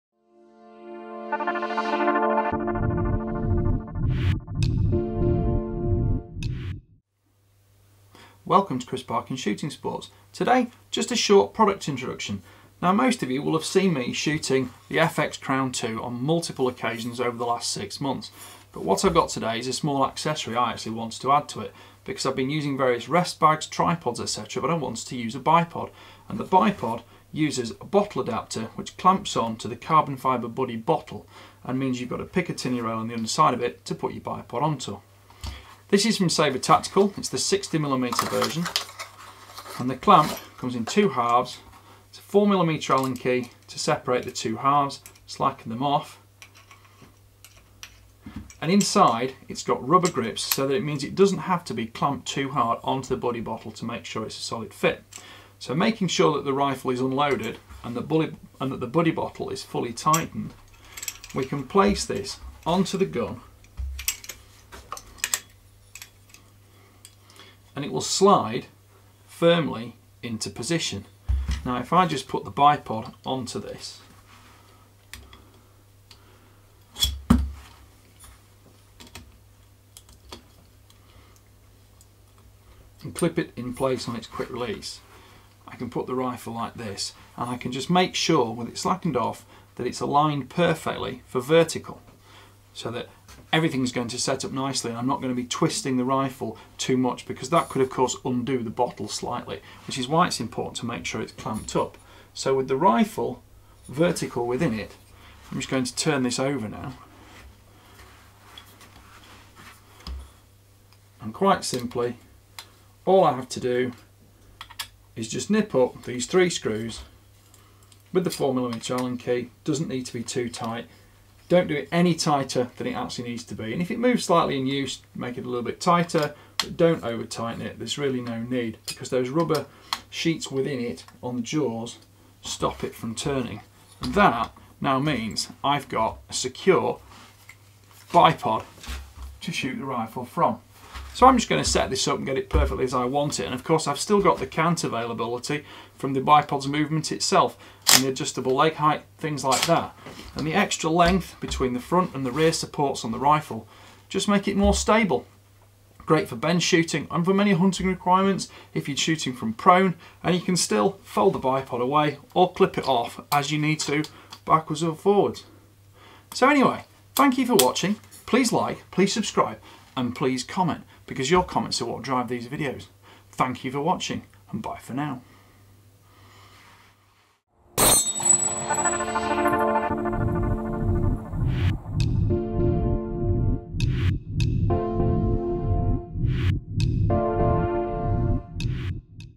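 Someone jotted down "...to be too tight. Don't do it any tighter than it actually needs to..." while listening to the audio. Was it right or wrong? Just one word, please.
right.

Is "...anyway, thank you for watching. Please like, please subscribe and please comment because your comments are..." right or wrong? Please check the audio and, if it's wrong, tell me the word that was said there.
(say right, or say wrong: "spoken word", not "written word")
right.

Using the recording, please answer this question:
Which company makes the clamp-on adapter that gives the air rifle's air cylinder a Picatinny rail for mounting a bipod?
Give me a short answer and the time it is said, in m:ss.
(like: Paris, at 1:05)
Saber Tactical, at 0:36.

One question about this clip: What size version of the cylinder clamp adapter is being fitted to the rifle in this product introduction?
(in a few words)
60mm.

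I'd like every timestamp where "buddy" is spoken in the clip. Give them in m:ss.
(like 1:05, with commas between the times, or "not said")
0:30, 0:53, 0:58.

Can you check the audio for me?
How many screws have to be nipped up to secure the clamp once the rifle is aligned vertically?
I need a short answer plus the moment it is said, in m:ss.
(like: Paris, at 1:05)
3, at 1:56.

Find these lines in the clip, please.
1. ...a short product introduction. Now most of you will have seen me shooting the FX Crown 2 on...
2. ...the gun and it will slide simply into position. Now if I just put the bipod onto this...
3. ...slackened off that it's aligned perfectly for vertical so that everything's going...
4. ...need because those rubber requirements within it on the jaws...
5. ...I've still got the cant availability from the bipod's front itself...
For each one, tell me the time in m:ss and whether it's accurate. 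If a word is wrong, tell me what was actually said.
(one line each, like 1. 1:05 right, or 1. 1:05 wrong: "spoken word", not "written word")
1. 0:11 right
2. 1:02 wrong: "firmly", not "simply"
3. 1:28 right
4. 2:08 wrong: "sheets", not "requirements"
5. 2:23 wrong: "movement", not "front".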